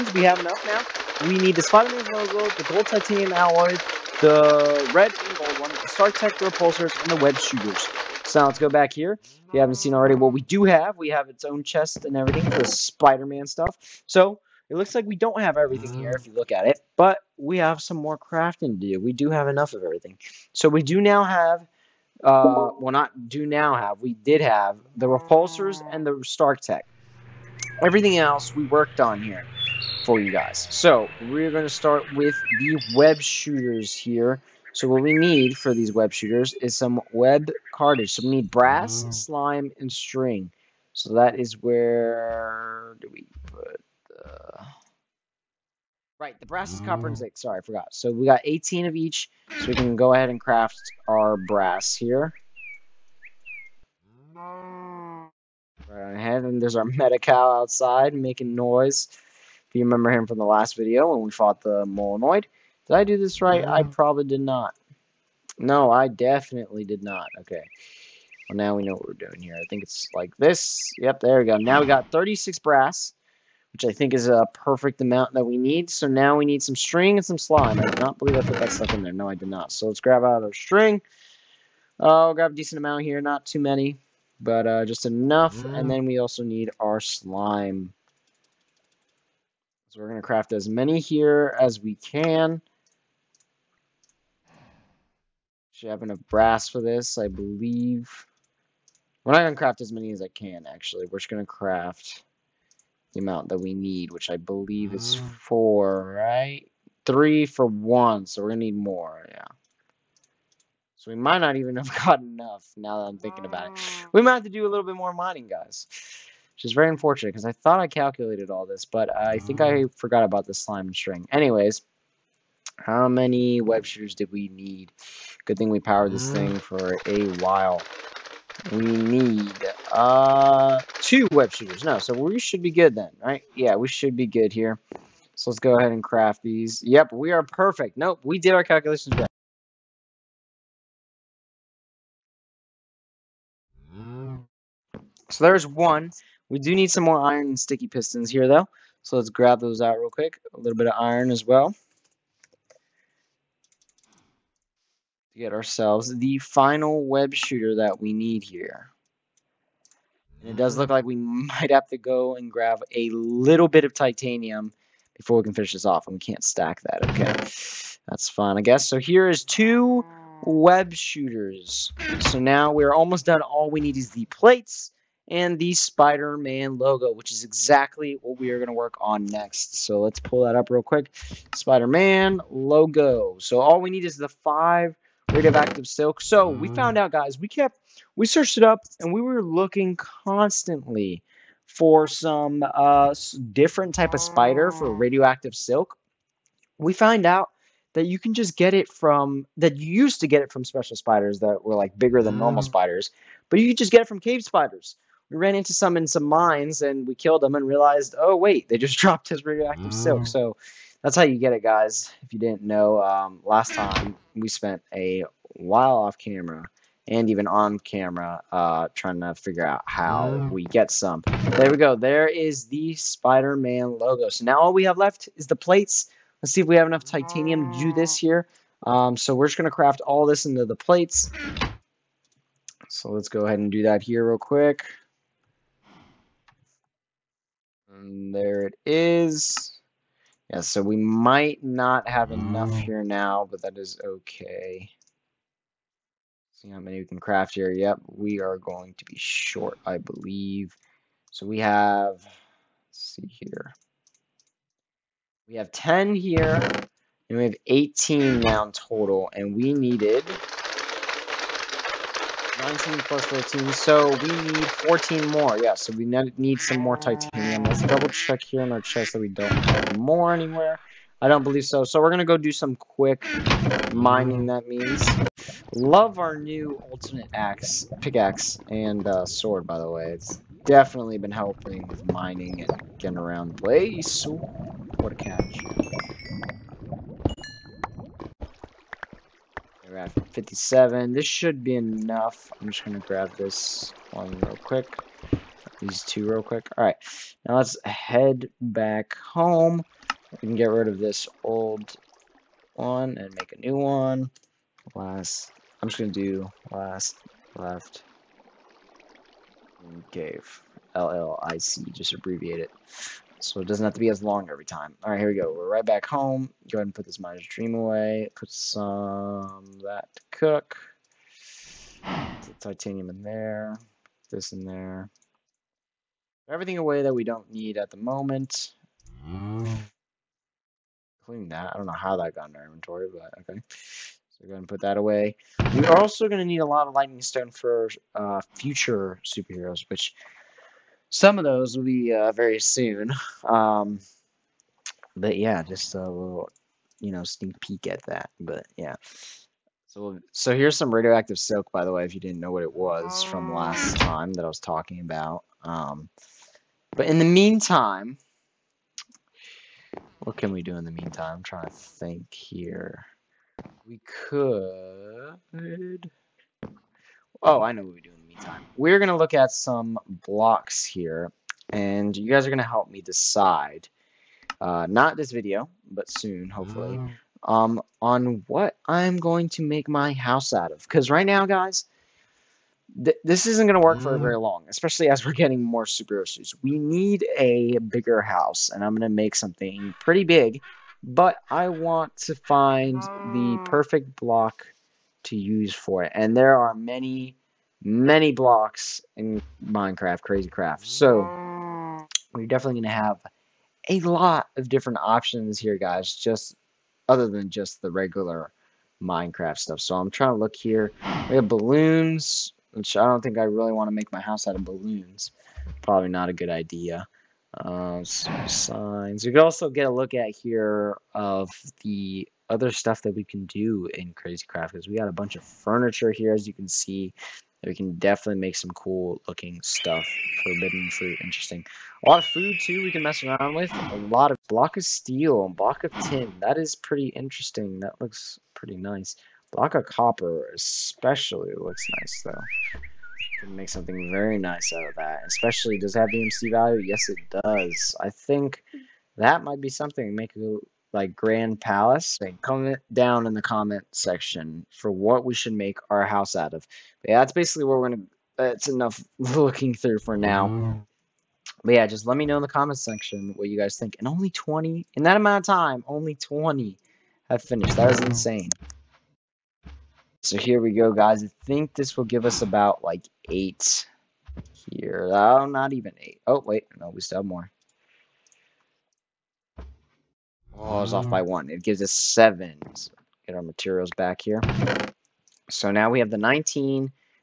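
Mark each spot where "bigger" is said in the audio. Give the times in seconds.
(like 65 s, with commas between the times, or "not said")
201 s, 387 s.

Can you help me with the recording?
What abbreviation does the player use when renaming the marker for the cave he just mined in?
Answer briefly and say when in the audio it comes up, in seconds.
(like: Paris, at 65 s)
LLIC, at 310 s.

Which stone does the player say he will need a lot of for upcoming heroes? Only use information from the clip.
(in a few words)
lightning stone.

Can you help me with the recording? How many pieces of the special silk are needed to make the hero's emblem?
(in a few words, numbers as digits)
5.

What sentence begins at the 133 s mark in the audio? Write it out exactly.
Yeah, we should be good here.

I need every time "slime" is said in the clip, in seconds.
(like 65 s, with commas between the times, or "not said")
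39 s, 77 s, 86 s, 120 s.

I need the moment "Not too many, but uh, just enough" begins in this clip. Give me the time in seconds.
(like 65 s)
83 s.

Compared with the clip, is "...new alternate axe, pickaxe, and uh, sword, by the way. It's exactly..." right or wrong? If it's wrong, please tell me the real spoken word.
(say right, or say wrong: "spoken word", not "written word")
wrong: "definitely", not "exactly".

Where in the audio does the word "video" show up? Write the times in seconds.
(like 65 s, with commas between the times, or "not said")
60 s, 375 s.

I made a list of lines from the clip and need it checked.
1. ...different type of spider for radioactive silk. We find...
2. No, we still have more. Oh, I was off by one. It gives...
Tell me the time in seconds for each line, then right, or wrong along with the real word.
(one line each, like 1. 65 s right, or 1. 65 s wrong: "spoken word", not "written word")
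1. 193 s right
2. 476 s right.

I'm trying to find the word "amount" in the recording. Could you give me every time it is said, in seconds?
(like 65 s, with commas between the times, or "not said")
74 s, 82 s, 103 s, 465 s.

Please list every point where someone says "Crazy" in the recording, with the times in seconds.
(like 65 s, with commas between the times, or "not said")
400 s, 424 s.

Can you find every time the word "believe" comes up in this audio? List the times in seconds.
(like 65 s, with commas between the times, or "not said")
78 s, 97 s, 104 s, 249 s, 271 s.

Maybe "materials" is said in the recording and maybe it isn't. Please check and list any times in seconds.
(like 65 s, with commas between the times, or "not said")
483 s.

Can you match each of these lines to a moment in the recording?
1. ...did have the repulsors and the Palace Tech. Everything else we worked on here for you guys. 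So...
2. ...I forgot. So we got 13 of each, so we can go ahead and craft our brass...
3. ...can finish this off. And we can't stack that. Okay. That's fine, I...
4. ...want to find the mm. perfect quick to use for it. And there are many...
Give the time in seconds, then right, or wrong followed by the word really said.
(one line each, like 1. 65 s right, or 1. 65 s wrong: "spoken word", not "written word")
1. 24 s wrong: "Stark", not "Palace"
2. 47 s wrong: "18", not "13"
3. 165 s right
4. 391 s wrong: "block", not "quick".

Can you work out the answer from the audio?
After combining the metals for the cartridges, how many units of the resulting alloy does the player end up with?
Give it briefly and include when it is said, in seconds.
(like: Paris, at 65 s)
36, at 72 s.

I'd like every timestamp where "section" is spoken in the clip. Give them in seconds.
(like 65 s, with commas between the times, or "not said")
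453 s, 462 s.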